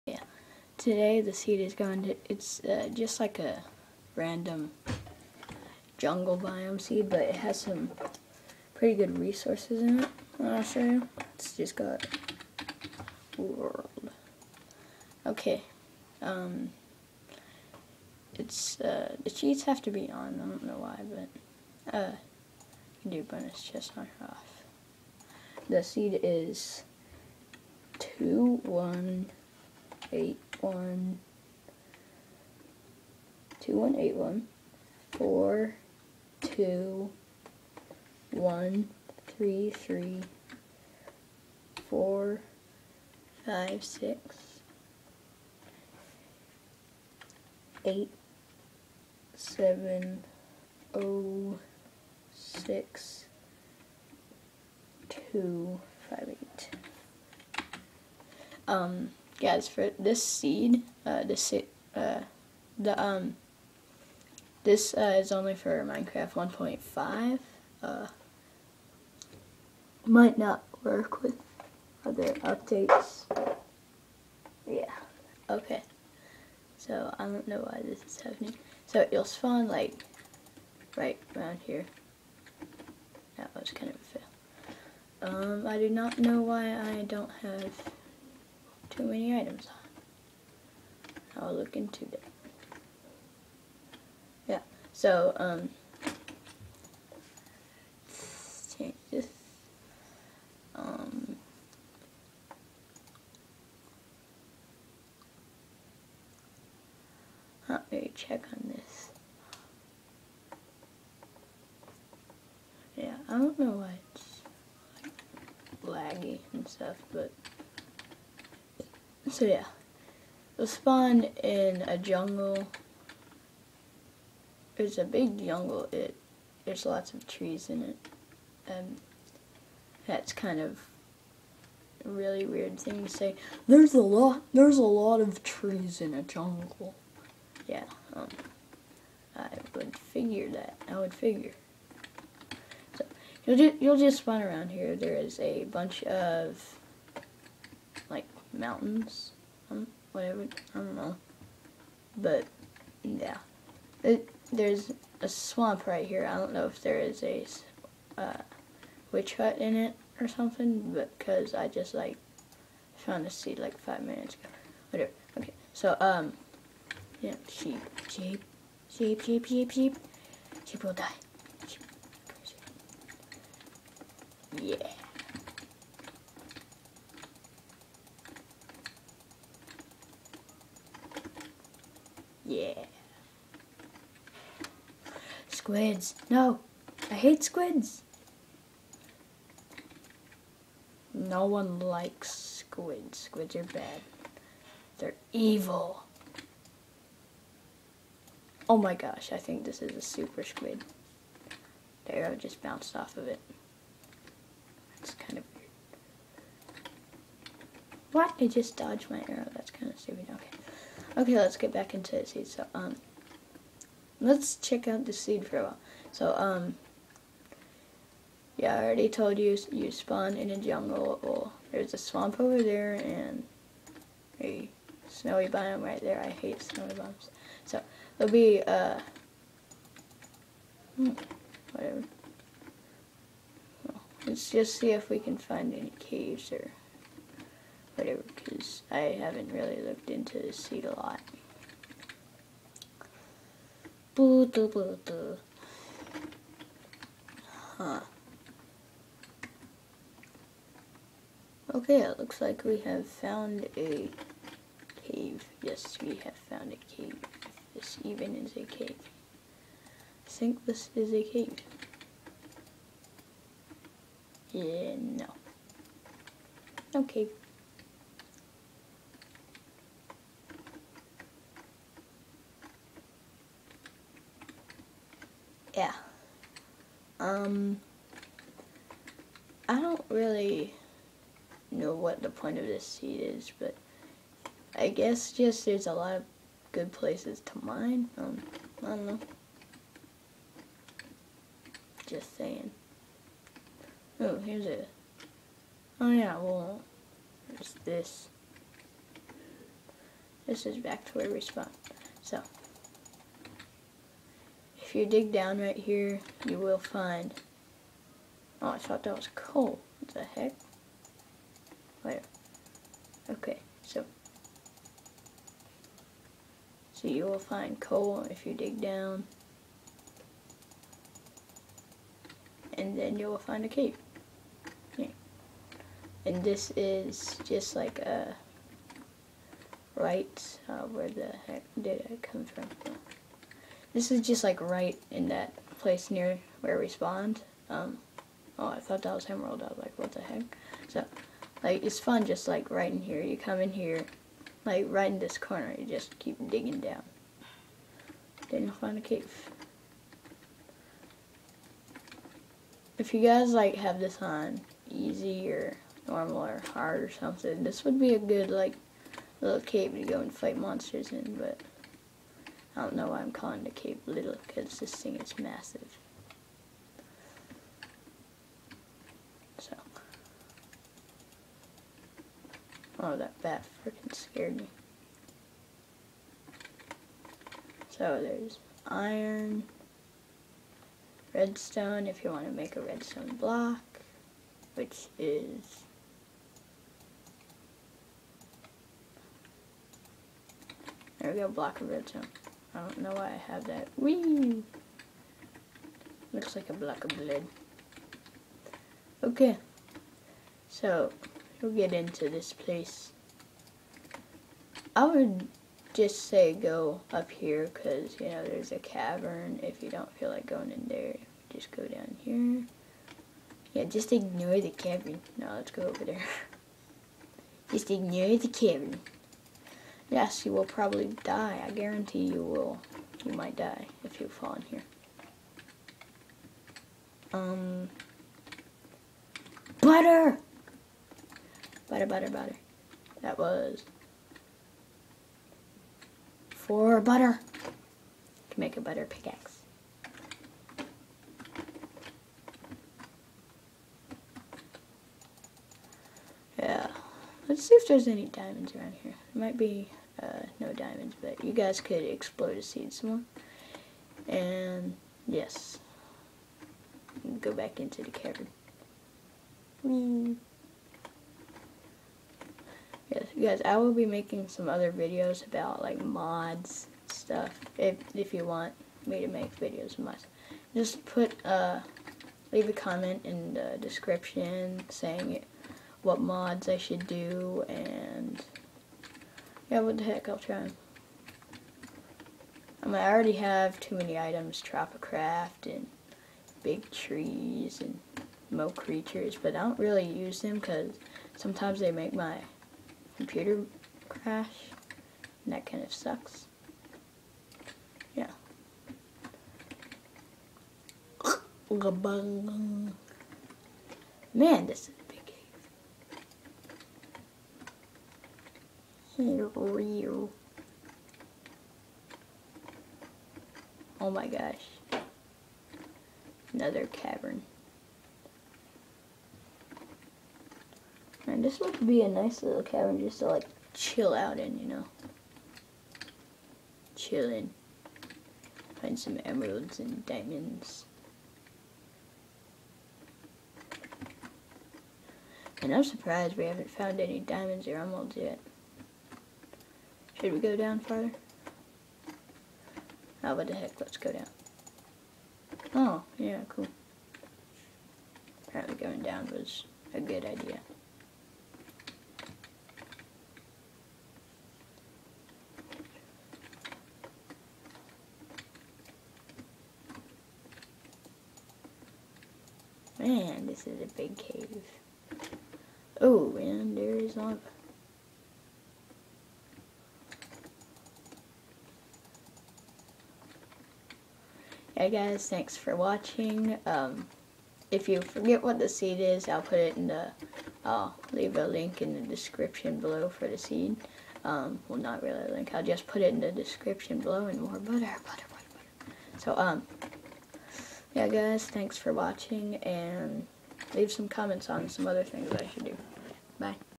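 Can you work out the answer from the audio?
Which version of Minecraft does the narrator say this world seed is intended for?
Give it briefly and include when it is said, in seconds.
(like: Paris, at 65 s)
1.5, at 65 s.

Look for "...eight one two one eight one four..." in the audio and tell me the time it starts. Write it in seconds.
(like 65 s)
30 s.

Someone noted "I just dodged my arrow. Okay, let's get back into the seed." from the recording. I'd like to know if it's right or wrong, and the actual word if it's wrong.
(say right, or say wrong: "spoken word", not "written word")
right.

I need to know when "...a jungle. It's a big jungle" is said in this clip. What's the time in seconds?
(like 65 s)
121 s.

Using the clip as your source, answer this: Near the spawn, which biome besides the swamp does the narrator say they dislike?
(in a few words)
Snowy biome.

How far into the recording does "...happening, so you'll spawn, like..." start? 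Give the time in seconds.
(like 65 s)
78 s.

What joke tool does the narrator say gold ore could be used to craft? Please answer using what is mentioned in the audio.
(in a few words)
Butter pickaxe.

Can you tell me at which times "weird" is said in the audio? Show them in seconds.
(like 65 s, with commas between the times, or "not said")
132 s, 205 s.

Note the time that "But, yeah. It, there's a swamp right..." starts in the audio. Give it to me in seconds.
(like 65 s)
152 s.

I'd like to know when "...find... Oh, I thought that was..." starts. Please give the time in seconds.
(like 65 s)
306 s.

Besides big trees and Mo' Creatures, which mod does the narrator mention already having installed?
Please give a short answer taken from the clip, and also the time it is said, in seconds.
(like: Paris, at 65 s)
Tropicraft, at 484 s.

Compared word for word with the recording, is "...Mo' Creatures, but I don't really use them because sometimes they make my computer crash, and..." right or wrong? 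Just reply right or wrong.
right.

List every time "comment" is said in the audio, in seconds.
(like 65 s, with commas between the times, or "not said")
472 s, 594 s.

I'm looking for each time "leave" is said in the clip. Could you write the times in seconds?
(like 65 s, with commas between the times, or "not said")
472 s, 581 s, 593 s.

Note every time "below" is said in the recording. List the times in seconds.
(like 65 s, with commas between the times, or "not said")
582 s, 586 s.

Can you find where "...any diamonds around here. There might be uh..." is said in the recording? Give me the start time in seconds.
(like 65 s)
448 s.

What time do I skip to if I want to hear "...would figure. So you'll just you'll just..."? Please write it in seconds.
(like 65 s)
140 s.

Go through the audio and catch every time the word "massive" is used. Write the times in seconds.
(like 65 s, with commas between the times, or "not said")
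365 s.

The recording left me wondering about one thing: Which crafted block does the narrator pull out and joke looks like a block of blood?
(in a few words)
Block of redstone.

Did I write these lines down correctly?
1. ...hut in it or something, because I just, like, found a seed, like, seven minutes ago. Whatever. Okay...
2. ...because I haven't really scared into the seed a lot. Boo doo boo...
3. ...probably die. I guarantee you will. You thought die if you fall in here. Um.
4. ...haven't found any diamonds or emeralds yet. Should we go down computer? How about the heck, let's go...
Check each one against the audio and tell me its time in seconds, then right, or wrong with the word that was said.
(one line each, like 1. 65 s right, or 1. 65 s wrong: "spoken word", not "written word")
1. 159 s wrong: "five", not "seven"
2. 238 s wrong: "looked", not "scared"
3. 420 s wrong: "might", not "thought"
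4. 536 s wrong: "farther", not "computer".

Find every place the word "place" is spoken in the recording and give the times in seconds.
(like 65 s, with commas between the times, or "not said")
286 s, 335 s, 402 s.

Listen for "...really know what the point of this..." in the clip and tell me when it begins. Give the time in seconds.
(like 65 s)
280 s.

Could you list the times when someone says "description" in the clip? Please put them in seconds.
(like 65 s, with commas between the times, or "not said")
473 s, 582 s, 586 s.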